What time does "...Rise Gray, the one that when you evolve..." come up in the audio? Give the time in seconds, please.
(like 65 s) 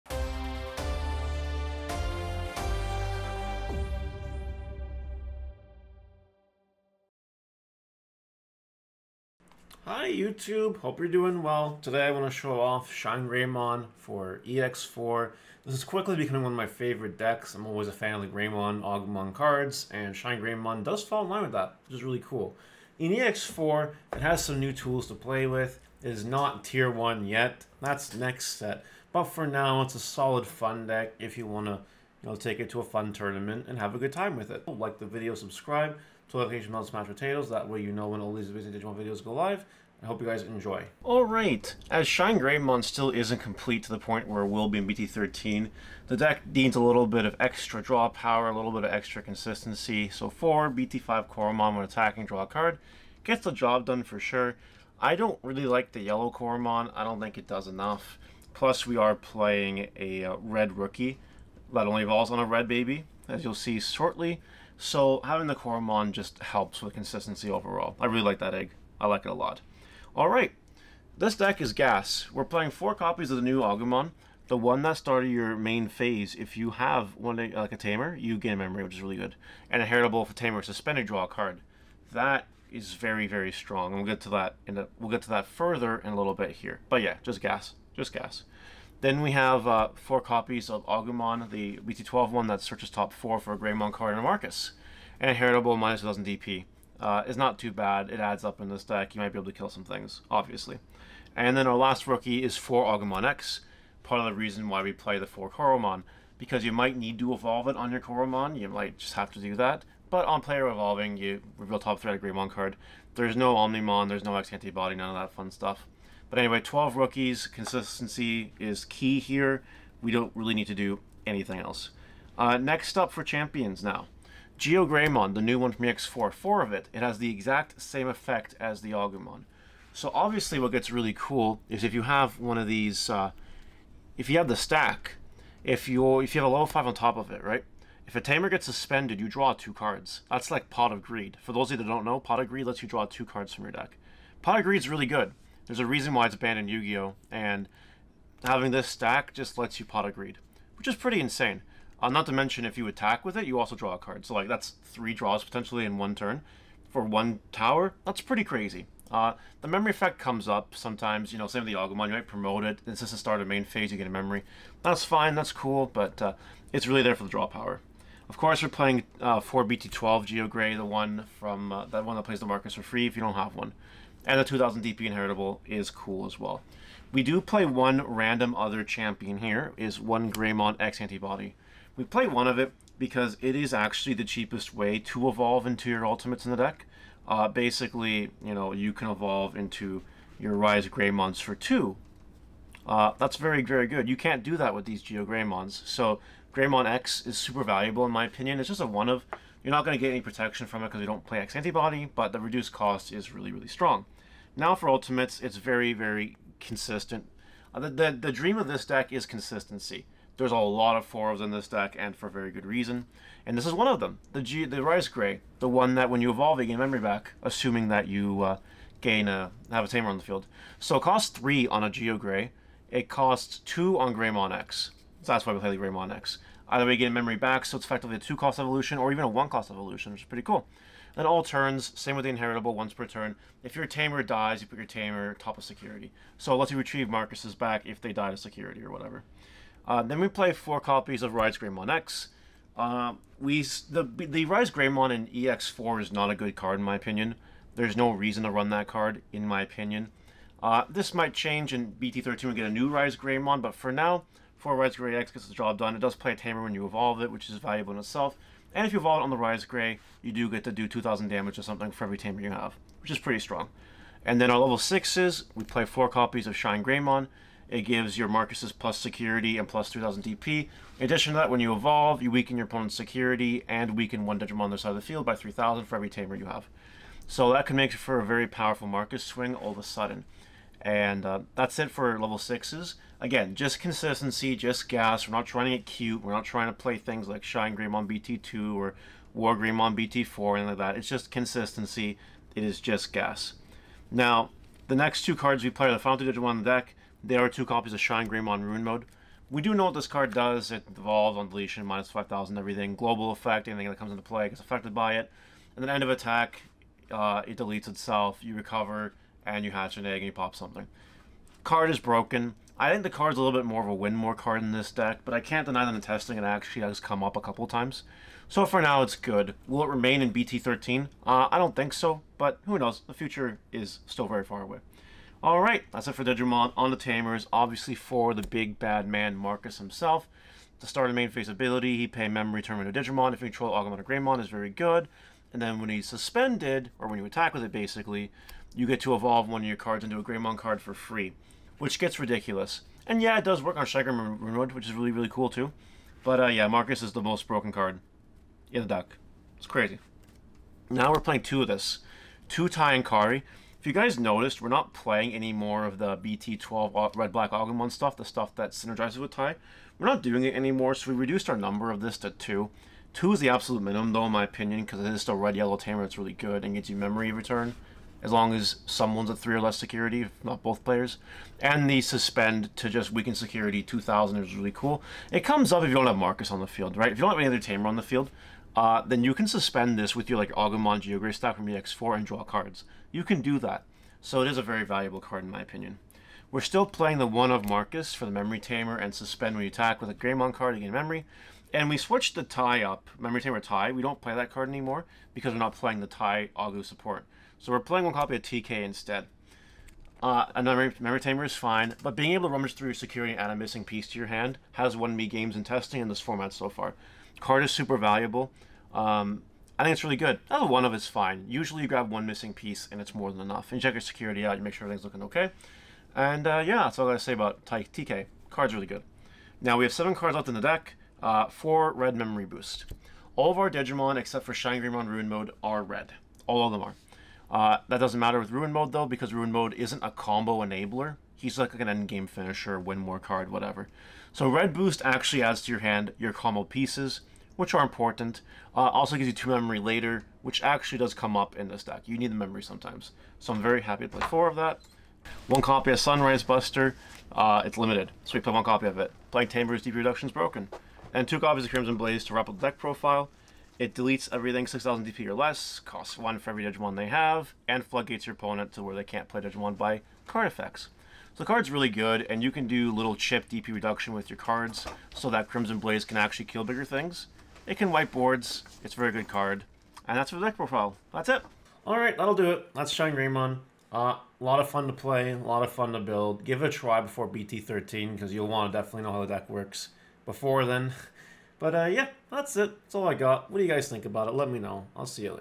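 214 s.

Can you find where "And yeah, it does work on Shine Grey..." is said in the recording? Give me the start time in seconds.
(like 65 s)
343 s.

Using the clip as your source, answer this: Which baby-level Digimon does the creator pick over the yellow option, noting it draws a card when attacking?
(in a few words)
BT5 Koromon.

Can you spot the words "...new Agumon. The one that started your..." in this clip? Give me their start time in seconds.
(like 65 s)
73 s.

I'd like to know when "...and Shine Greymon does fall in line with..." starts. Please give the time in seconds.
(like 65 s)
19 s.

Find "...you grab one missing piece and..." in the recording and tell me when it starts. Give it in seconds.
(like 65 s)
411 s.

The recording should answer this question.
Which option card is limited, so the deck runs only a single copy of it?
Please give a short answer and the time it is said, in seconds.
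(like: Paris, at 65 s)
Sunrise Buster, at 445 s.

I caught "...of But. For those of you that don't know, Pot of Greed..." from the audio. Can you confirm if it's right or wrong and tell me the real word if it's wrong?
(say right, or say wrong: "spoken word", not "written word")
wrong: "Greed", not "But".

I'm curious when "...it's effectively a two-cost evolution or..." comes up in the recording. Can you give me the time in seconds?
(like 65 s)
227 s.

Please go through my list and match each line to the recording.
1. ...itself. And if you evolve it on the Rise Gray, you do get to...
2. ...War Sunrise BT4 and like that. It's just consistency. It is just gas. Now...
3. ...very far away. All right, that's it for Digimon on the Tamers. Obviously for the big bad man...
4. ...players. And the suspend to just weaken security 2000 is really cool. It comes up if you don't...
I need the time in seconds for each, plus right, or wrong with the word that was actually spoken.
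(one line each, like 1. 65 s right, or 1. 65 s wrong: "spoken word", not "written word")
1. 257 s right
2. 289 s wrong: "Greymon", not "Sunrise"
3. 324 s right
4. 370 s right.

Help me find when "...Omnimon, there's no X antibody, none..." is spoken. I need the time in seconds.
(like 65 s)
113 s.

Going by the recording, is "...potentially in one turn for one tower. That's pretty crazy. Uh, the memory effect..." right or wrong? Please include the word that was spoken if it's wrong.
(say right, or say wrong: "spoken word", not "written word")
right.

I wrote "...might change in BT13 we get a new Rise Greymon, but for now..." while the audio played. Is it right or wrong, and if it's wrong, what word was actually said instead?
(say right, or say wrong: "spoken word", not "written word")
right.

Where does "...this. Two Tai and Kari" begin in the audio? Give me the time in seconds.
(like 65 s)
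351 s.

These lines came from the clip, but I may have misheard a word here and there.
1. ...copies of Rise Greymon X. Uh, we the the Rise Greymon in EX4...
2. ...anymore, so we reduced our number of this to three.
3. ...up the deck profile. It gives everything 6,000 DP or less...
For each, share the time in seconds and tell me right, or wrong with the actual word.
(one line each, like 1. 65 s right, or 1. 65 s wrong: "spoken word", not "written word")
1. 240 s right
2. 360 s wrong: "two", not "three"
3. 452 s wrong: "deletes", not "gives".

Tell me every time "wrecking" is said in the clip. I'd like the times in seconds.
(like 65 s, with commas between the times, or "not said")
not said.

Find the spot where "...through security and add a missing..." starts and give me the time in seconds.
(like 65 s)
402 s.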